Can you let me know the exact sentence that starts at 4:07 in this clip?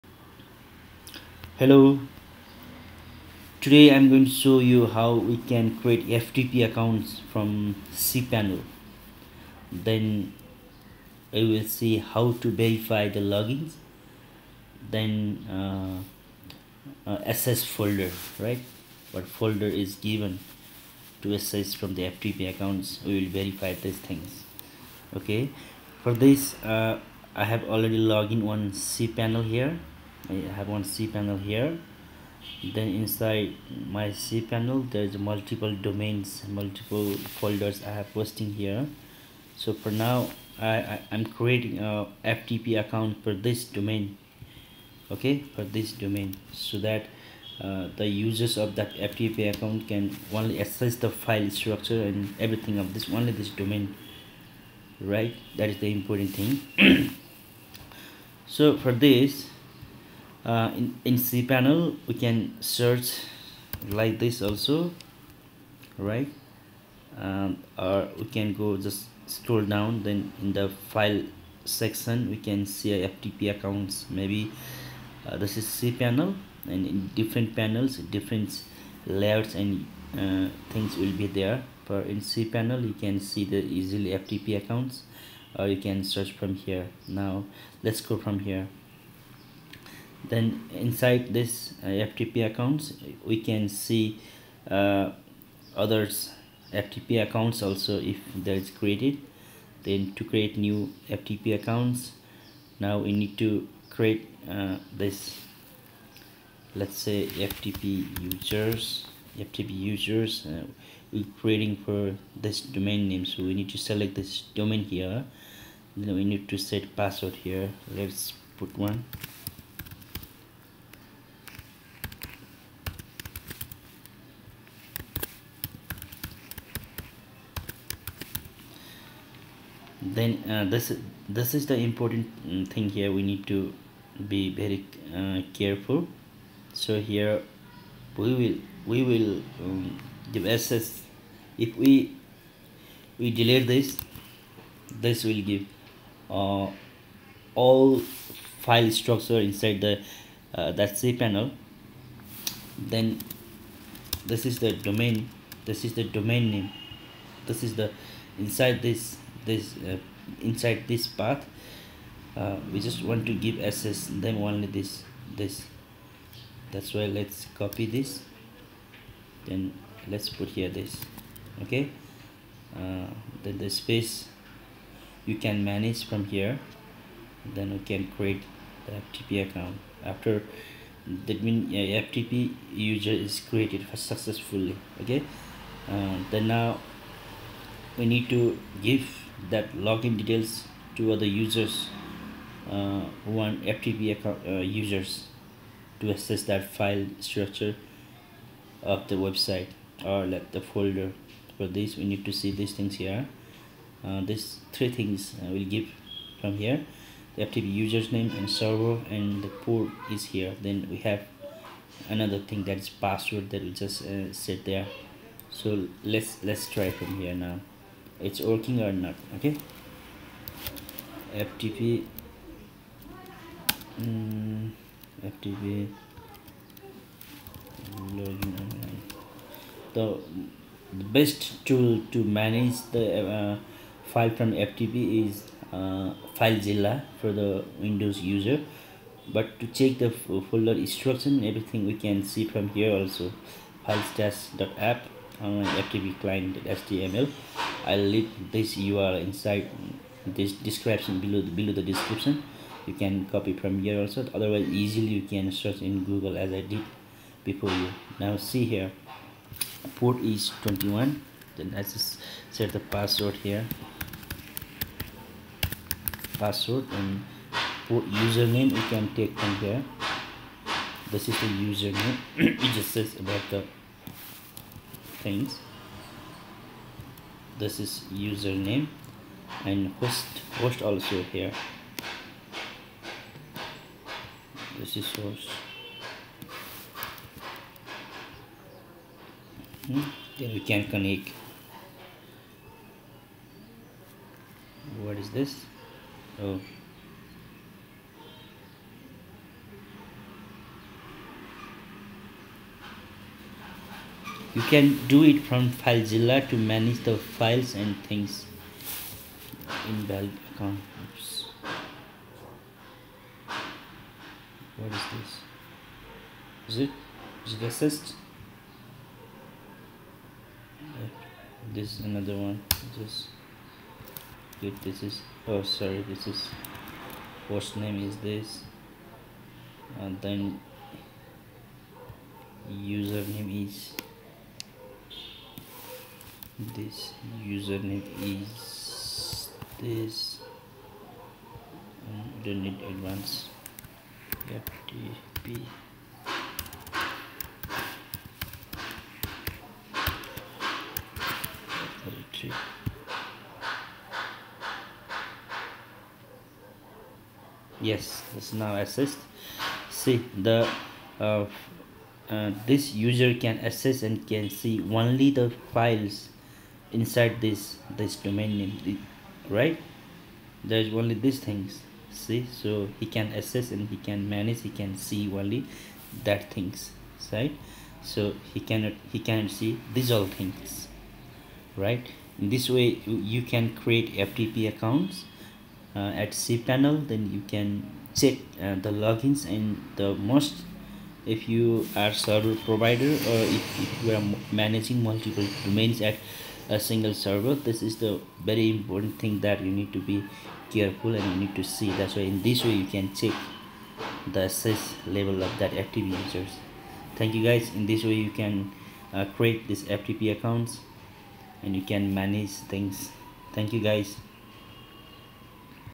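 I'll leave this URL inside this description below the, below the description.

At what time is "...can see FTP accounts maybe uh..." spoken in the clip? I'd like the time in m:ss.
1:12.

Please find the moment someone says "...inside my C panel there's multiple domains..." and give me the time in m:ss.
0:32.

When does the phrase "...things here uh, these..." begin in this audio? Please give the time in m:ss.
3:22.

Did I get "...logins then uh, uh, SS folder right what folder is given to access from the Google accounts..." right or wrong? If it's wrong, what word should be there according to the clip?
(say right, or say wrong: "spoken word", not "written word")
wrong: "FTP", not "Google".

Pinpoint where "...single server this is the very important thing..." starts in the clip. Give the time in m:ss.
6:36.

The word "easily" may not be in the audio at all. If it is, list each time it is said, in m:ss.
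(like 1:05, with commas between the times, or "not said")
1:23, 4:14.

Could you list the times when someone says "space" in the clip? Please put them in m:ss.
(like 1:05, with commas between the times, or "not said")
2:53.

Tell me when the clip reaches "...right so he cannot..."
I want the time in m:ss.
6:17.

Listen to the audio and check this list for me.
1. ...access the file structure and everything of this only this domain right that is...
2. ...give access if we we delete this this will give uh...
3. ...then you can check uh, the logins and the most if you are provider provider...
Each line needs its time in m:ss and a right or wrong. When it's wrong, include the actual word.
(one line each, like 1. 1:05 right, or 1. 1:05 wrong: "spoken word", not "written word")
1. 0:50 right
2. 2:20 right
3. 6:27 wrong: "server", not "provider".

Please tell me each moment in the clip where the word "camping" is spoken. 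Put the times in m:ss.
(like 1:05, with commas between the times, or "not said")
not said.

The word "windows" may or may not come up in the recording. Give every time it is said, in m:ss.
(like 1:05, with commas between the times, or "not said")
3:57.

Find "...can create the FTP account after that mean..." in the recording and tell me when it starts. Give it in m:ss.
2:57.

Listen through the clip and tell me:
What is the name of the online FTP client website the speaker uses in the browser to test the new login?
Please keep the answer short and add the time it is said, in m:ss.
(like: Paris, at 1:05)
filestash.app, at 4:03.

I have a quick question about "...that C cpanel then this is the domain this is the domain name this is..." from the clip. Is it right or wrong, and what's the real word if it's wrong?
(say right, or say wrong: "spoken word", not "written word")
wrong: "panel", not "cpanel".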